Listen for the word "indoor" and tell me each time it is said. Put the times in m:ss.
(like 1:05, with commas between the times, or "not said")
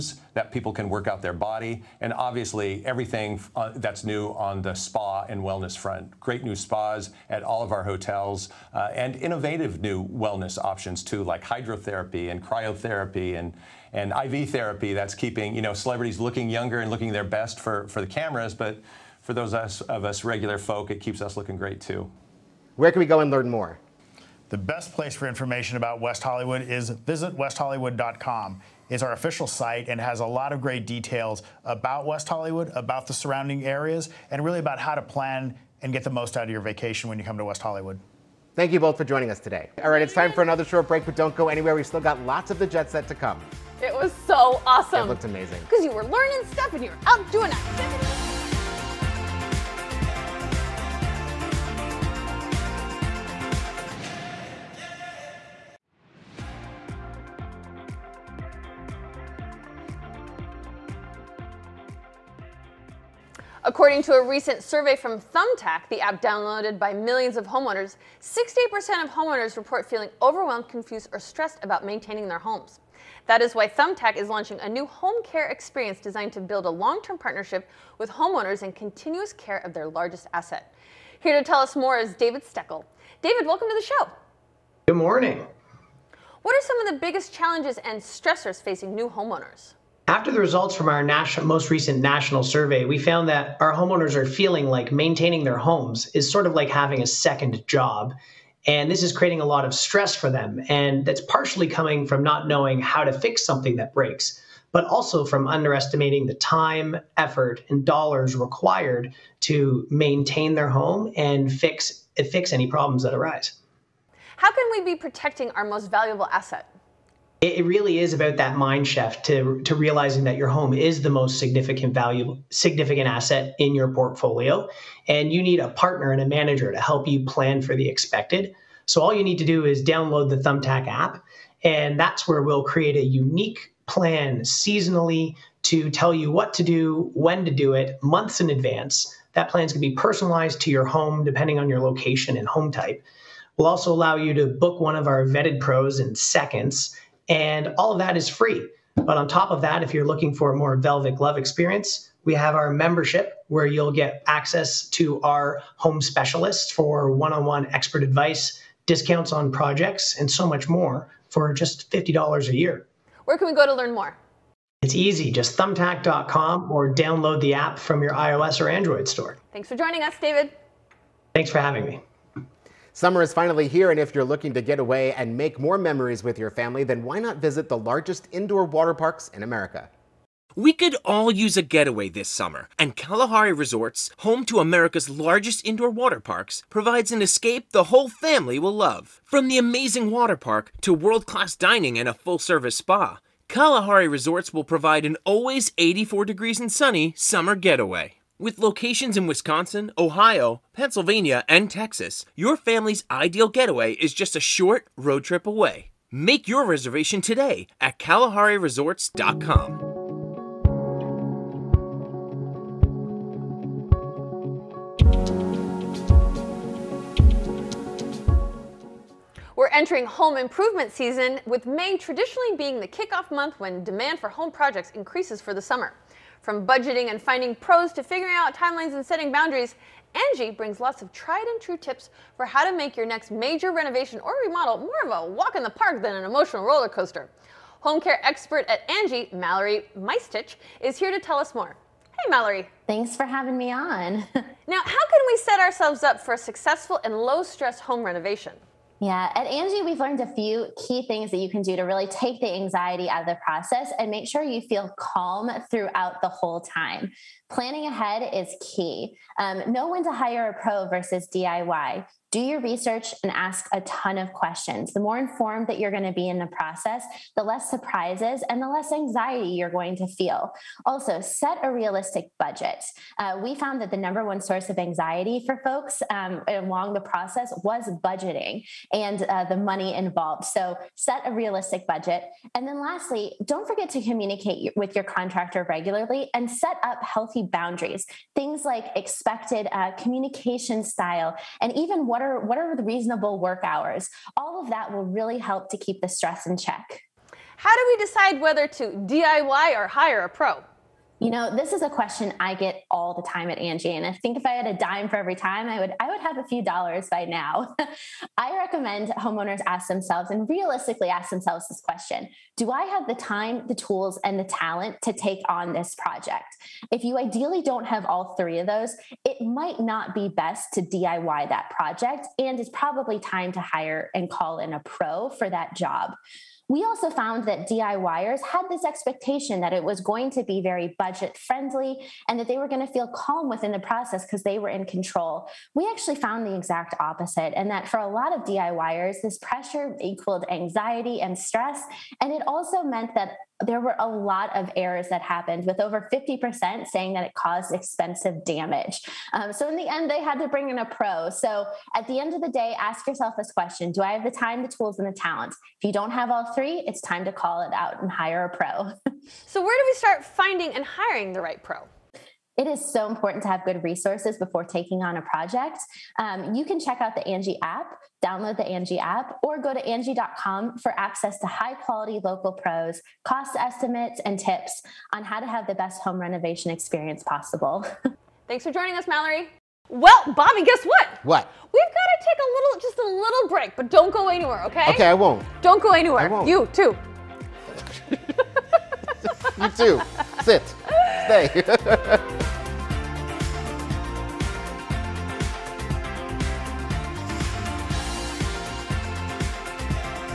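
2:58, 3:05.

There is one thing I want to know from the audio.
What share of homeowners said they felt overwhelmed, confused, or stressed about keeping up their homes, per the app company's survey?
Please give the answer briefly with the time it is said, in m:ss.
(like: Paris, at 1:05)
68%, at 1:08.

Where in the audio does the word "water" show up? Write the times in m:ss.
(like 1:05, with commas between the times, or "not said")
2:58, 3:05, 3:10.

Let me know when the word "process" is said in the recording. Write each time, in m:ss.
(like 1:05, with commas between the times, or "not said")
4:13, 4:26, 4:36, 5:33.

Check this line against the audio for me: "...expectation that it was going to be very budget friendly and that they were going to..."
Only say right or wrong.
right.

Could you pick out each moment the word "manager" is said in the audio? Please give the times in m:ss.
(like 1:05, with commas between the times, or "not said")
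2:06.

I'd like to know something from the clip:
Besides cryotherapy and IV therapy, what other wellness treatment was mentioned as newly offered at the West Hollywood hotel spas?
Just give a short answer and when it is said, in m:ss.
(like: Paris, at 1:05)
hydrotherapy, at 0:11.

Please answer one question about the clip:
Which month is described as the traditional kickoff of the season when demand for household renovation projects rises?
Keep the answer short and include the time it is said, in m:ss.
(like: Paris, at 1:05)
May, at 3:41.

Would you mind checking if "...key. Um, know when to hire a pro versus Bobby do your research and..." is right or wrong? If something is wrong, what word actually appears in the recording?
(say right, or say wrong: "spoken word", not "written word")
wrong: "DIY", not "Bobby".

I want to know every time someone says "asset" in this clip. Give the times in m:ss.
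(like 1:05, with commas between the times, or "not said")
1:20, 1:56, 2:03.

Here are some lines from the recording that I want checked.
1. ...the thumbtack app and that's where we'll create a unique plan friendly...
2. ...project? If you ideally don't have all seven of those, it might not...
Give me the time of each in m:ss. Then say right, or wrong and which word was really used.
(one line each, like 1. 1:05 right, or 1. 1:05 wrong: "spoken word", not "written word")
1. 2:10 wrong: "seasonally", not "friendly"
2. 5:15 wrong: "three", not "seven".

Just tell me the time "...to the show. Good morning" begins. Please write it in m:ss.
1:23.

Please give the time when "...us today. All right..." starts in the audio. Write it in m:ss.
0:39.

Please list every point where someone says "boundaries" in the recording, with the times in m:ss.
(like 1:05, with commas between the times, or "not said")
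3:49, 4:47.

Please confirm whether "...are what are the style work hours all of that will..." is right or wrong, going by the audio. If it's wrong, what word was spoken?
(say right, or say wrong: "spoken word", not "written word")
wrong: "reasonable", not "style".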